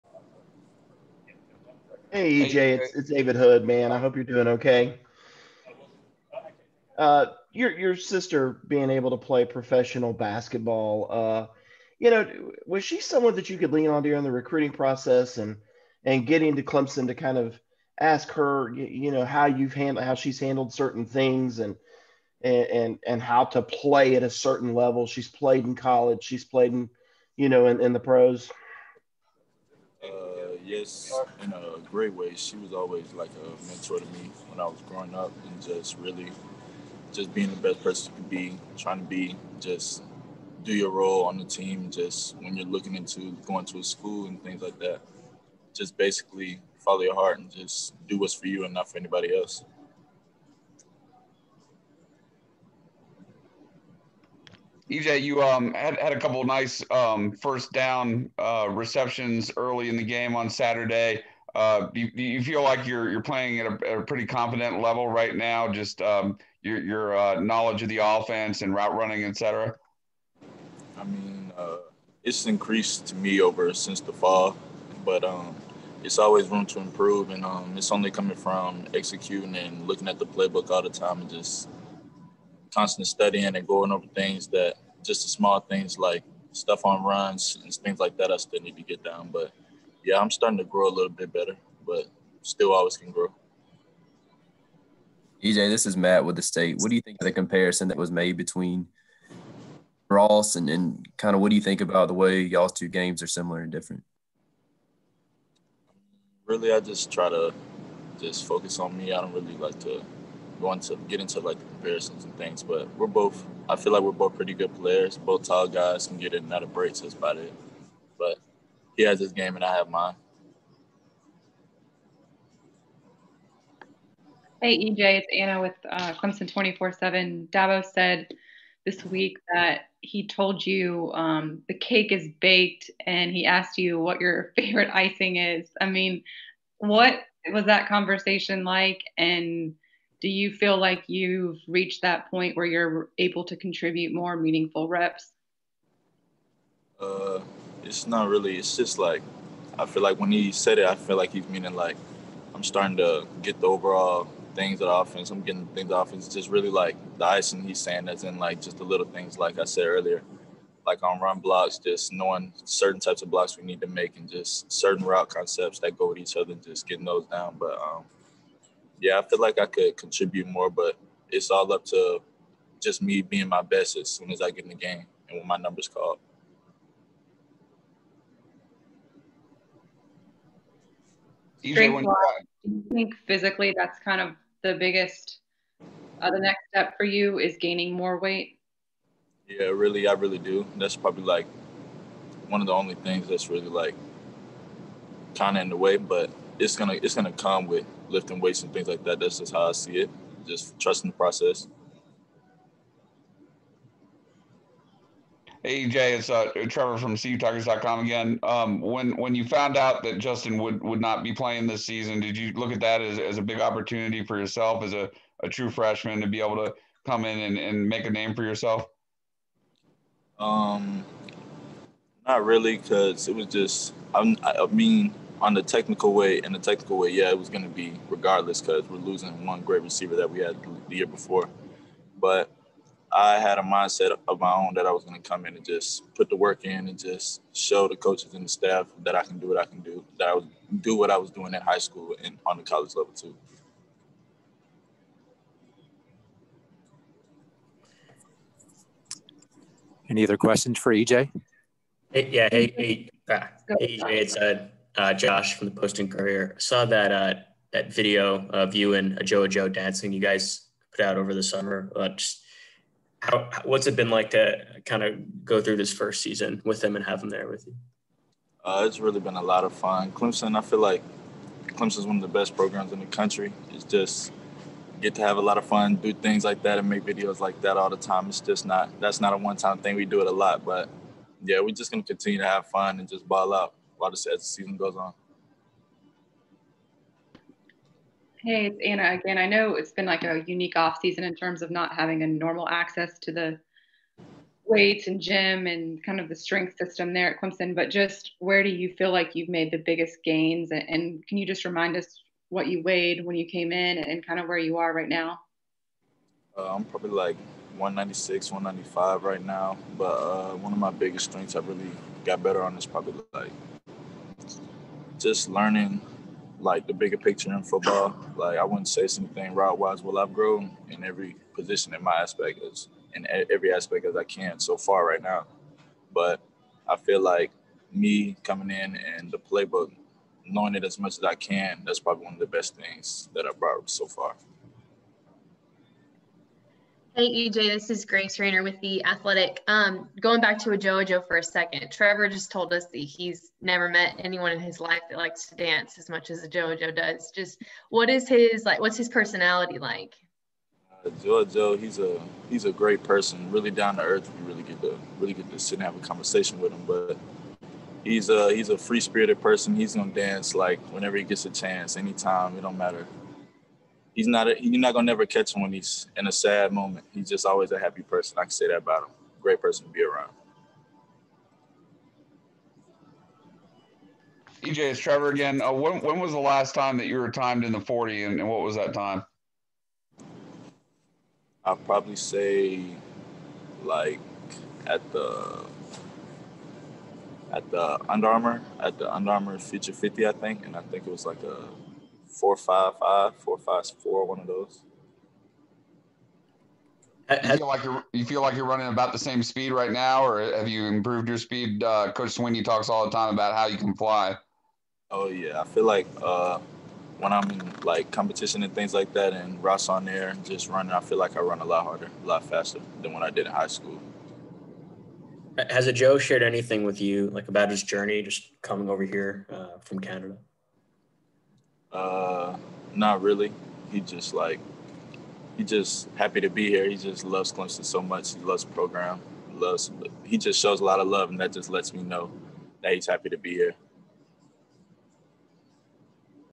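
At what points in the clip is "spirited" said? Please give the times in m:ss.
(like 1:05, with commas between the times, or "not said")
5:59.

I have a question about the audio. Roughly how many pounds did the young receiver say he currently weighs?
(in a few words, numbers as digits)
196.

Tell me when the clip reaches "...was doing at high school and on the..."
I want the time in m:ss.
4:01.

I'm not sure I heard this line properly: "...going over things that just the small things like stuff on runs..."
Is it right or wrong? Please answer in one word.
right.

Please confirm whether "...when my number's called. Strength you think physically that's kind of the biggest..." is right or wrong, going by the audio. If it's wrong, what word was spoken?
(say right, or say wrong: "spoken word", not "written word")
right.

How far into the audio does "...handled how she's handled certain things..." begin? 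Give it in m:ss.
0:19.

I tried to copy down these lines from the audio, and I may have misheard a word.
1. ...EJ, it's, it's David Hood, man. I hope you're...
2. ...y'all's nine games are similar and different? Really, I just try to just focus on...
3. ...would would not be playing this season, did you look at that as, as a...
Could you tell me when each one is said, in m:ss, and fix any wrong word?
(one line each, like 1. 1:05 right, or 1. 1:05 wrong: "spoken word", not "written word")
1. 0:02 right
2. 1:42 wrong: "two", not "nine"
3. 3:30 right.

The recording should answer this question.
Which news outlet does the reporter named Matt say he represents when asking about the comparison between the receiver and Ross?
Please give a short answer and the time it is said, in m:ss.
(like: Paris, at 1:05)
The State, at 1:36.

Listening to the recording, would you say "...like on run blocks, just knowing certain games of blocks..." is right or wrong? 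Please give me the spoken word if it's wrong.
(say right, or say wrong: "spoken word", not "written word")
wrong: "types", not "games".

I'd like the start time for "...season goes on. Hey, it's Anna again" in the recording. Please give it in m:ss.
4:44.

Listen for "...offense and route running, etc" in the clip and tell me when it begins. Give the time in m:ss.
1:08.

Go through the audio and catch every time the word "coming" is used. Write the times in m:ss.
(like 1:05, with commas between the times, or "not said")
1:18, 5:28, 6:58.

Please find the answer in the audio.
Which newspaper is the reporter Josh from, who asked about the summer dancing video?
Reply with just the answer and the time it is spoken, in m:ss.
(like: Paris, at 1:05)
Post and Courier, at 4:15.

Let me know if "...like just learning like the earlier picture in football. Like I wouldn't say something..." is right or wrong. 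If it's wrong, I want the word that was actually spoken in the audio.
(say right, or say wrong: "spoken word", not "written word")
wrong: "bigger", not "earlier".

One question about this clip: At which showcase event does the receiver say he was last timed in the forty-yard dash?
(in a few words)
Under Armour Future 50.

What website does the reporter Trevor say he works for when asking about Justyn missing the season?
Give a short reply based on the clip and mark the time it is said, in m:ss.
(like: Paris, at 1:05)
CUTuckers.com, at 3:27.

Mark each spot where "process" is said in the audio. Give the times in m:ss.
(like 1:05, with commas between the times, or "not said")
0:14, 3:21.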